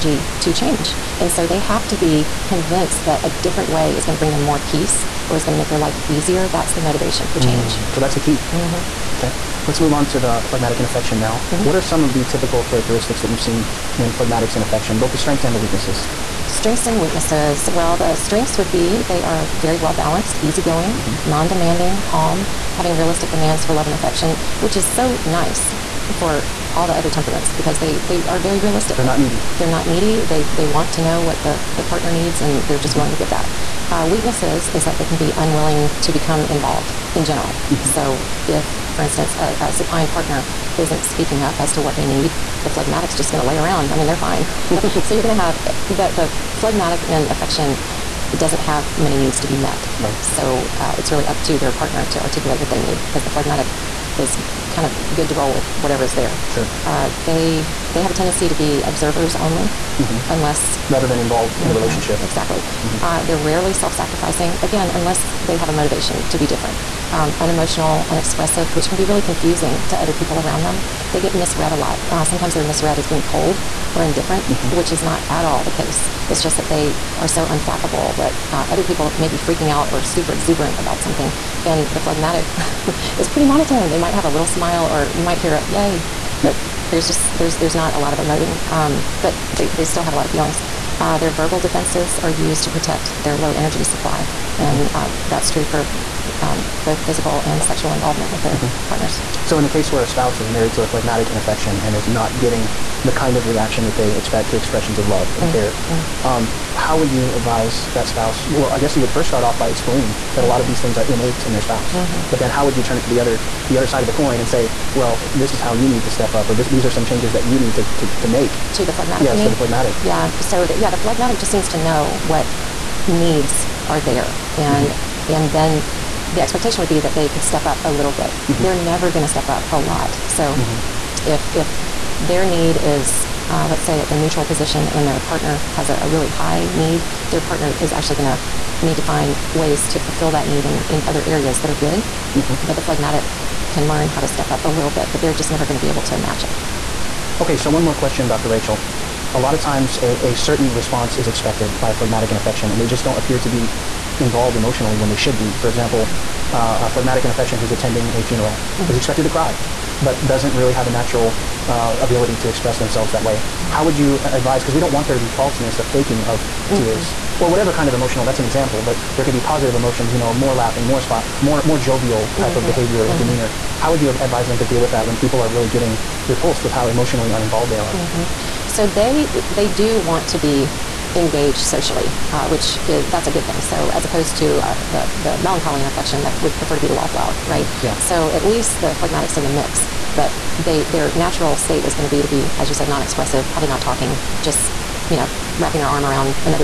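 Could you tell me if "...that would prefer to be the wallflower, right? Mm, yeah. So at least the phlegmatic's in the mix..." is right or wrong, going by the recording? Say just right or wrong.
right.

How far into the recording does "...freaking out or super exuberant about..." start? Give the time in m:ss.
1:19.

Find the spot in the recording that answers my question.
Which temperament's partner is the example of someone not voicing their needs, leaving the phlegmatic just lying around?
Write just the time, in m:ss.
0:39.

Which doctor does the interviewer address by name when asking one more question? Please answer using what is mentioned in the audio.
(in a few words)
Dr. Rachael.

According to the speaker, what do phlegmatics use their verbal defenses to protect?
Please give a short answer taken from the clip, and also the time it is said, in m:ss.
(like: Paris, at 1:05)
low energy supply, at 1:33.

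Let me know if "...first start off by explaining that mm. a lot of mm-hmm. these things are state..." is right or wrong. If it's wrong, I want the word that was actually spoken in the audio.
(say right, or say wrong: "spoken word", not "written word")
wrong: "innate", not "state".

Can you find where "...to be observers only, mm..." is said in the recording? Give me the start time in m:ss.
0:58.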